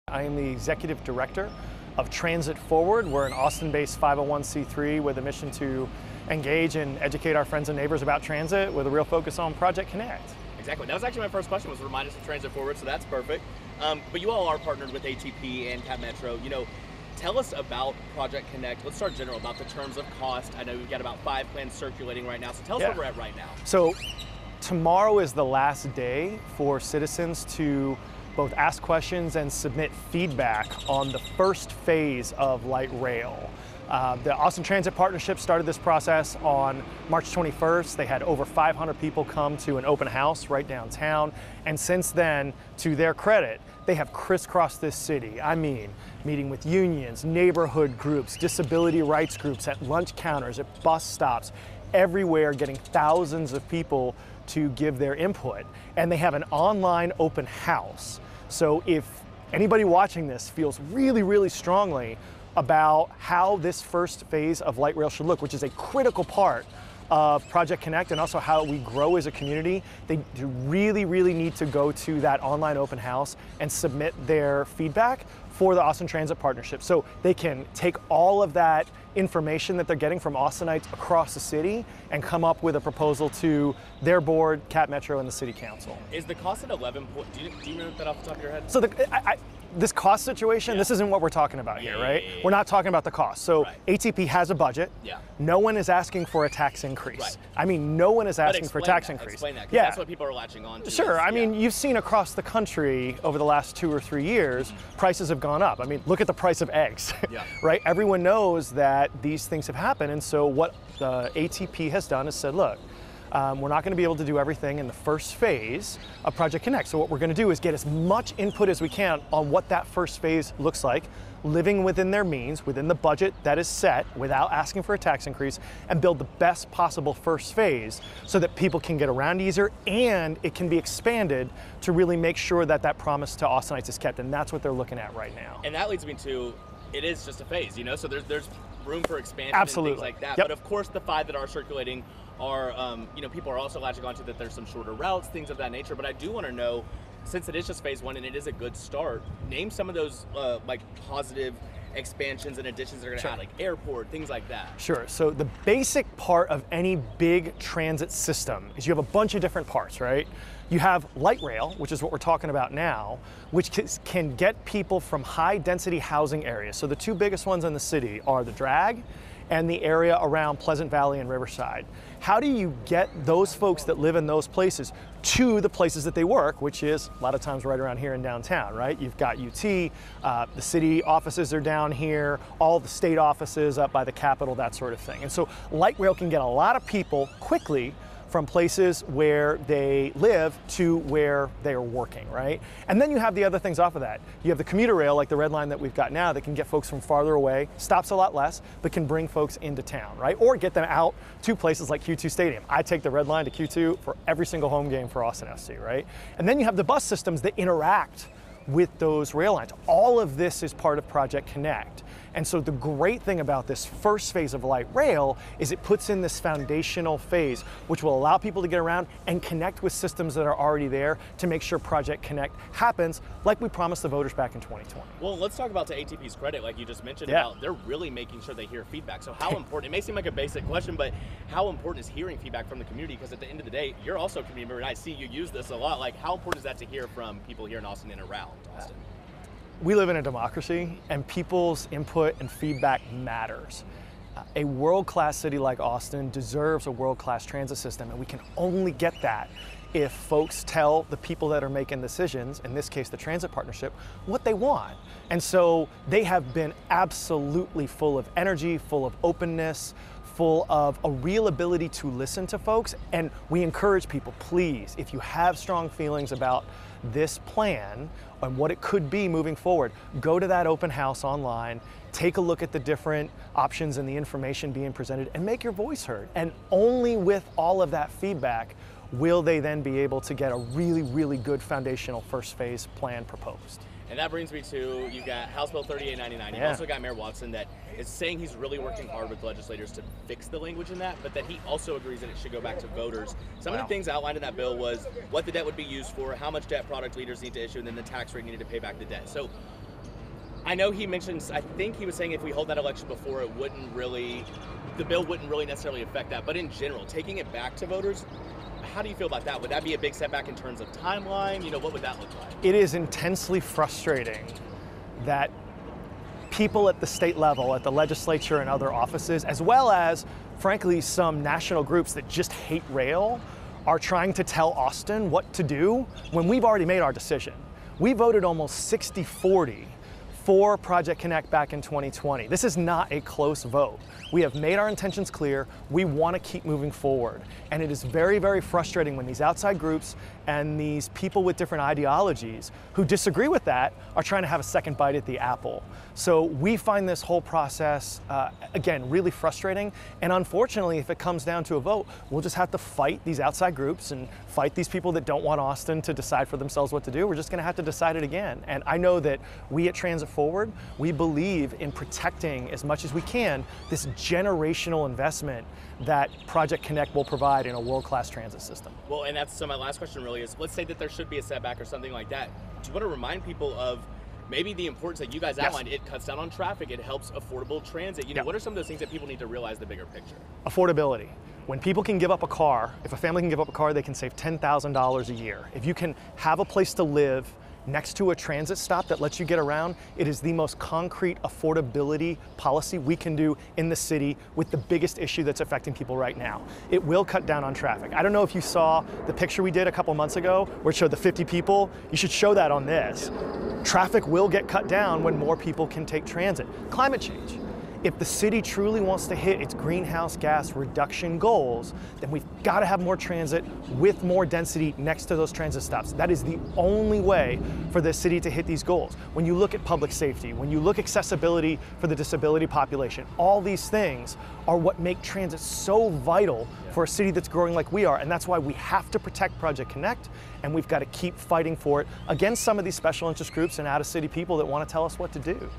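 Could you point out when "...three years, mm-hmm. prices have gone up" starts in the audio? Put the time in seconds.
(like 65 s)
104 s.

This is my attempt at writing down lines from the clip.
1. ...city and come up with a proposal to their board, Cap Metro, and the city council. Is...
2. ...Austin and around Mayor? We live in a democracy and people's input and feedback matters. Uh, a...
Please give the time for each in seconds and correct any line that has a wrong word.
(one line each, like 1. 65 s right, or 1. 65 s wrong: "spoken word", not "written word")
1. 81 s right
2. 237 s wrong: "Austin", not "Mayor".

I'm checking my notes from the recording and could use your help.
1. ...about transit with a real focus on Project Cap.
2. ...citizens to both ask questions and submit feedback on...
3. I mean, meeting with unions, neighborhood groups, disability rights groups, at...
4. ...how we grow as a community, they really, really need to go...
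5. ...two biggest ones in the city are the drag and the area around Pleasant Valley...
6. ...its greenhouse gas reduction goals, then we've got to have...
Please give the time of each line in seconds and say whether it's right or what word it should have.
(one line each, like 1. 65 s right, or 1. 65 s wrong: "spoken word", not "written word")
1. 8 s wrong: "Connect", not "Cap"
2. 26 s right
3. 45 s right
4. 68 s right
5. 166 s right
6. 409 s right.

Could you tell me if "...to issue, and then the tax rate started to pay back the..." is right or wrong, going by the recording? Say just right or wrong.
wrong.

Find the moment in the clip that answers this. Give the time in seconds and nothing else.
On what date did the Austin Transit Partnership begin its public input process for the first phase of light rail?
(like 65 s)
37 s.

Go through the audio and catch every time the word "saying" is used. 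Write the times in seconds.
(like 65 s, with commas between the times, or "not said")
288 s, 302 s.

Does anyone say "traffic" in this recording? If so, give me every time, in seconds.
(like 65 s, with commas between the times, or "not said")
376 s, 397 s, 403 s.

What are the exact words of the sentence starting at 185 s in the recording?
And so light rail can get a lot of people quickly from places where they live to where they are working, right?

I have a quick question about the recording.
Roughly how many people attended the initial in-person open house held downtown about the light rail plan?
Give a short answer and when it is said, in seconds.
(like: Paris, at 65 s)
over 500, at 38 s.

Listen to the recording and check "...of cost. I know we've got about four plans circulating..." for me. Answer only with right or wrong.
wrong.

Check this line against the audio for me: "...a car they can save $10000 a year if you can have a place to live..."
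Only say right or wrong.
right.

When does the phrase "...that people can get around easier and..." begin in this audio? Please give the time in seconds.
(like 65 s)
128 s.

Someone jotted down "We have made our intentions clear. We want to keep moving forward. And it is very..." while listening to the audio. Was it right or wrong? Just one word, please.
right.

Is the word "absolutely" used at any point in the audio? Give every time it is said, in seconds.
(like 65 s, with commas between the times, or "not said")
139 s, 256 s.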